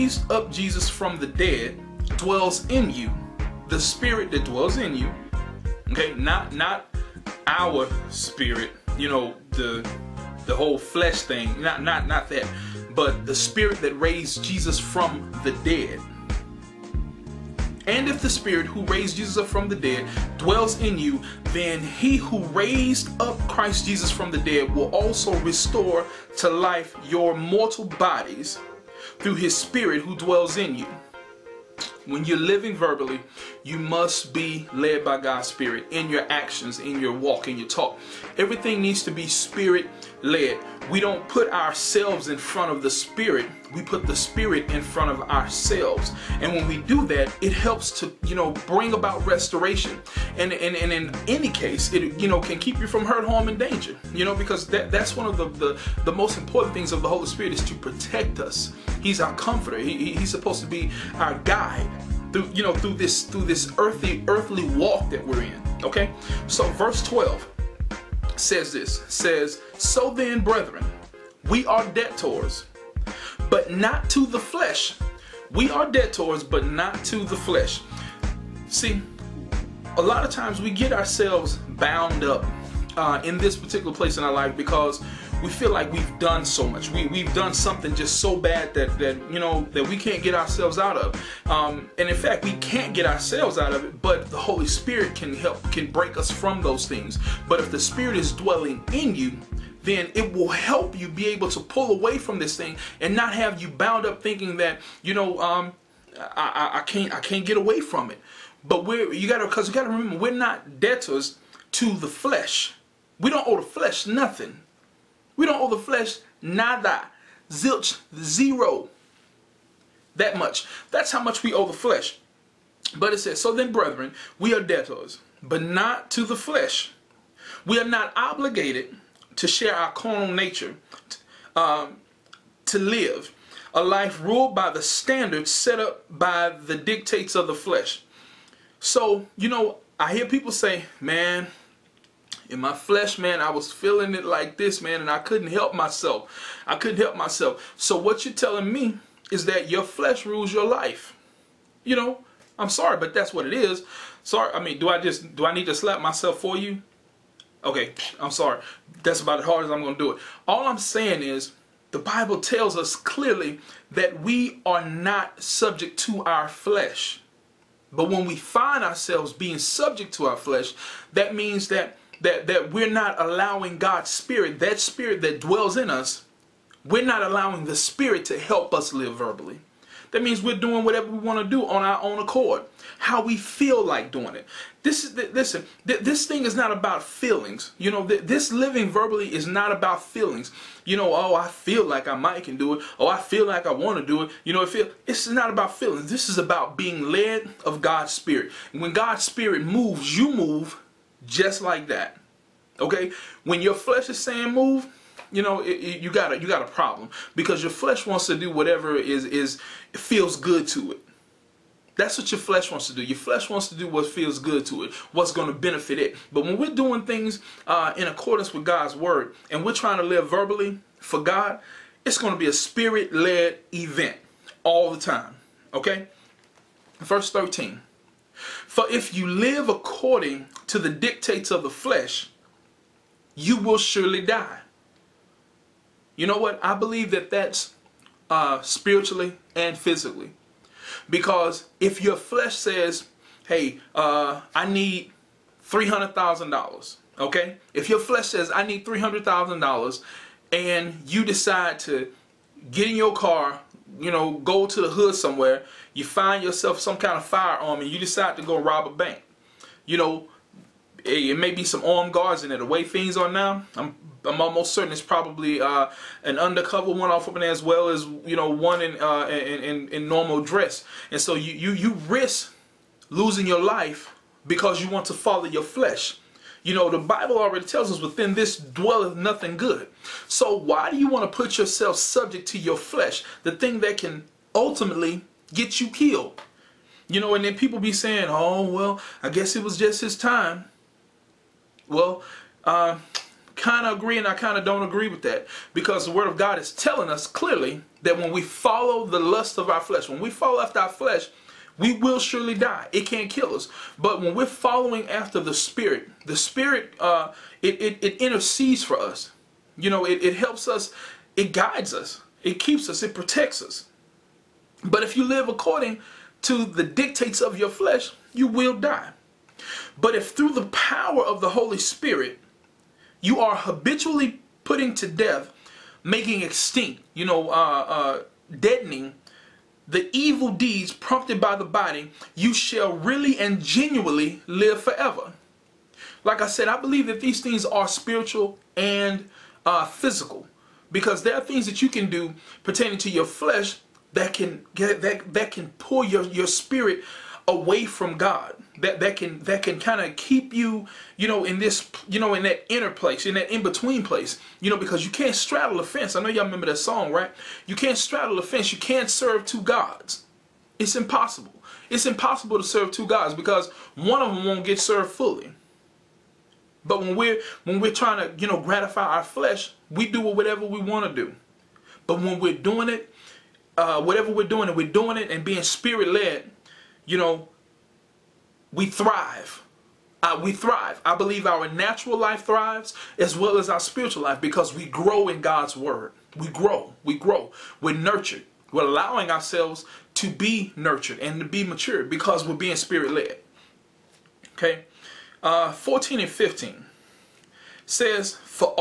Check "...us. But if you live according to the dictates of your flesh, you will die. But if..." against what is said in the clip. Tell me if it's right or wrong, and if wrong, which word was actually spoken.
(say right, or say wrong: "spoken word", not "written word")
right.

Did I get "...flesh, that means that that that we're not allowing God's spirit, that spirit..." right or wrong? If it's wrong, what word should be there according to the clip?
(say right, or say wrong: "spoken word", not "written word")
right.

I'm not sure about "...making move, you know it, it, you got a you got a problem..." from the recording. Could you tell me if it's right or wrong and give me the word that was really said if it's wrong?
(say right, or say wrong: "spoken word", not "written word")
wrong: "saying", not "making".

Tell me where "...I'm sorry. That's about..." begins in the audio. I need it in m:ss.
2:38.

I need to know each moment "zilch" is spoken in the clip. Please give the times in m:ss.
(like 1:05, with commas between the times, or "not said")
1:57.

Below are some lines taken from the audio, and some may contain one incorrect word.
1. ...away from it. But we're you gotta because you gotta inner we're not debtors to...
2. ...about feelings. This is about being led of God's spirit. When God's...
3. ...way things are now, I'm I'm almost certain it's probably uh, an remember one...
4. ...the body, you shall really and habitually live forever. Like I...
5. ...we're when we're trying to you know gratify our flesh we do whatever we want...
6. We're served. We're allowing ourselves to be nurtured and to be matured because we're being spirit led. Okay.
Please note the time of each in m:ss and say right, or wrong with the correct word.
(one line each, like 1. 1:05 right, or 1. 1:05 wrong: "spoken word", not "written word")
1. 1:47 wrong: "remember", not "inner"
2. 3:15 right
3. 4:22 wrong: "undercover", not "remember"
4. 5:31 wrong: "genuinely", not "habitually"
5. 6:07 right
6. 6:27 wrong: "nurtured", not "served".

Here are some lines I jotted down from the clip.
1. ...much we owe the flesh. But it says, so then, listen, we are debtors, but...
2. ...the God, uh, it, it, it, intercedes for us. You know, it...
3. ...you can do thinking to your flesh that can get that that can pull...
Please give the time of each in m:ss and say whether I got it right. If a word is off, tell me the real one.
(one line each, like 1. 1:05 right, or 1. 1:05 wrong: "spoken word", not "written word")
1. 2:01 wrong: "brethren", not "listen"
2. 5:06 wrong: "Spirit", not "God"
3. 5:41 wrong: "pertaining", not "thinking".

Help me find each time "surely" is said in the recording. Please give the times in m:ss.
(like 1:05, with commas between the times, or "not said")
3:53, 5:02.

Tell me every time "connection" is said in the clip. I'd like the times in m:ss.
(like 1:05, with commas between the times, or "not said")
not said.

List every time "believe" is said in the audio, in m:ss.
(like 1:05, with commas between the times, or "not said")
3:56, 5:36, 6:21.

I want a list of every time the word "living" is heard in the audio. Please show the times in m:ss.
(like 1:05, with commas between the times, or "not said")
0:32, 3:08.